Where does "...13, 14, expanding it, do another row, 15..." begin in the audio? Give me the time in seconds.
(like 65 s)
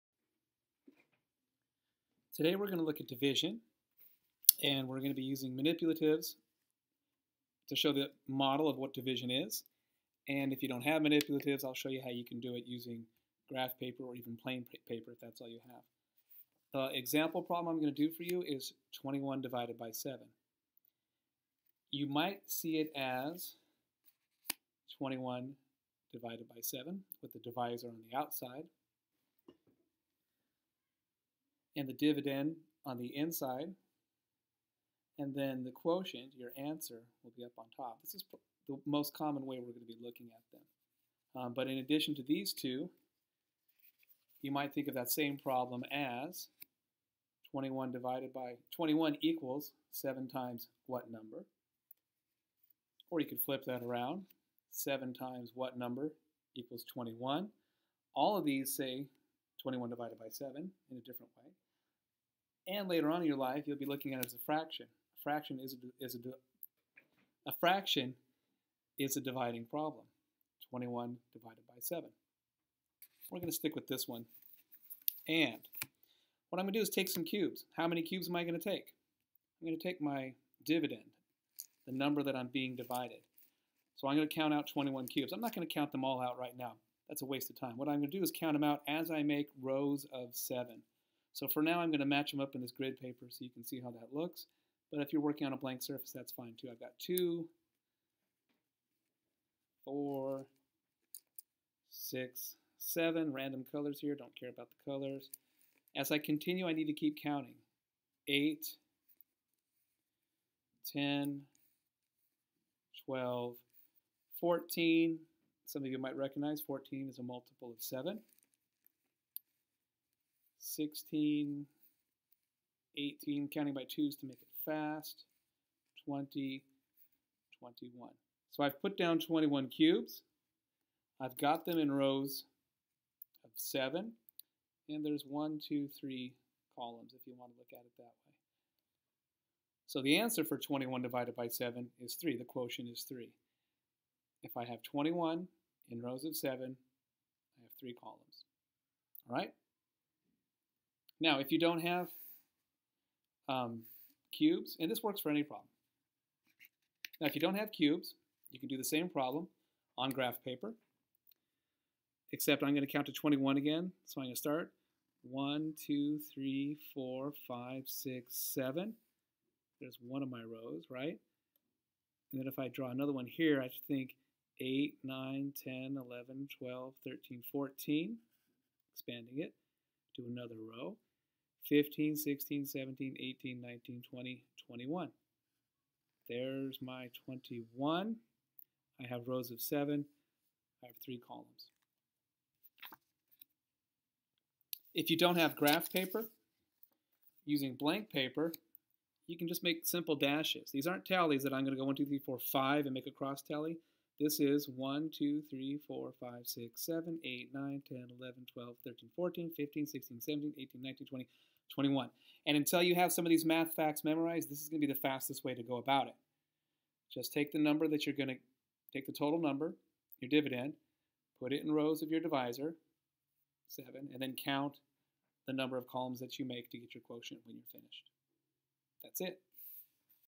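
177 s.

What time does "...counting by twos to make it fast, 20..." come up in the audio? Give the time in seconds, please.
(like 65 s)
123 s.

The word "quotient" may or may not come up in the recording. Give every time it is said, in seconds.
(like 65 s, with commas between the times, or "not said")
35 s, 142 s, 227 s.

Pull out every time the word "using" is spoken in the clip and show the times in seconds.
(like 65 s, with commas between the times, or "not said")
5 s, 12 s, 197 s.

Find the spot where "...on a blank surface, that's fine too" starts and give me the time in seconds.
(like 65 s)
95 s.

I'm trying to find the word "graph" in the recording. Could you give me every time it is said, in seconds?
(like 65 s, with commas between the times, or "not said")
13 s, 160 s, 195 s.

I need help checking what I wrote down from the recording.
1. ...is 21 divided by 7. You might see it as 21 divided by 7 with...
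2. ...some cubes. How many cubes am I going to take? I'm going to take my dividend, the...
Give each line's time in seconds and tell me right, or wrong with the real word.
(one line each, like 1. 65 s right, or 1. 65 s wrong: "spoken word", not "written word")
1. 18 s right
2. 77 s right.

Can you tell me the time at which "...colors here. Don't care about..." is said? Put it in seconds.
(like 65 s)
103 s.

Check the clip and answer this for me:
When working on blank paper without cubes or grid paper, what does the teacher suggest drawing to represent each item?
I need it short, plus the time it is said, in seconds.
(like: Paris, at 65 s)
simple dashes, at 199 s.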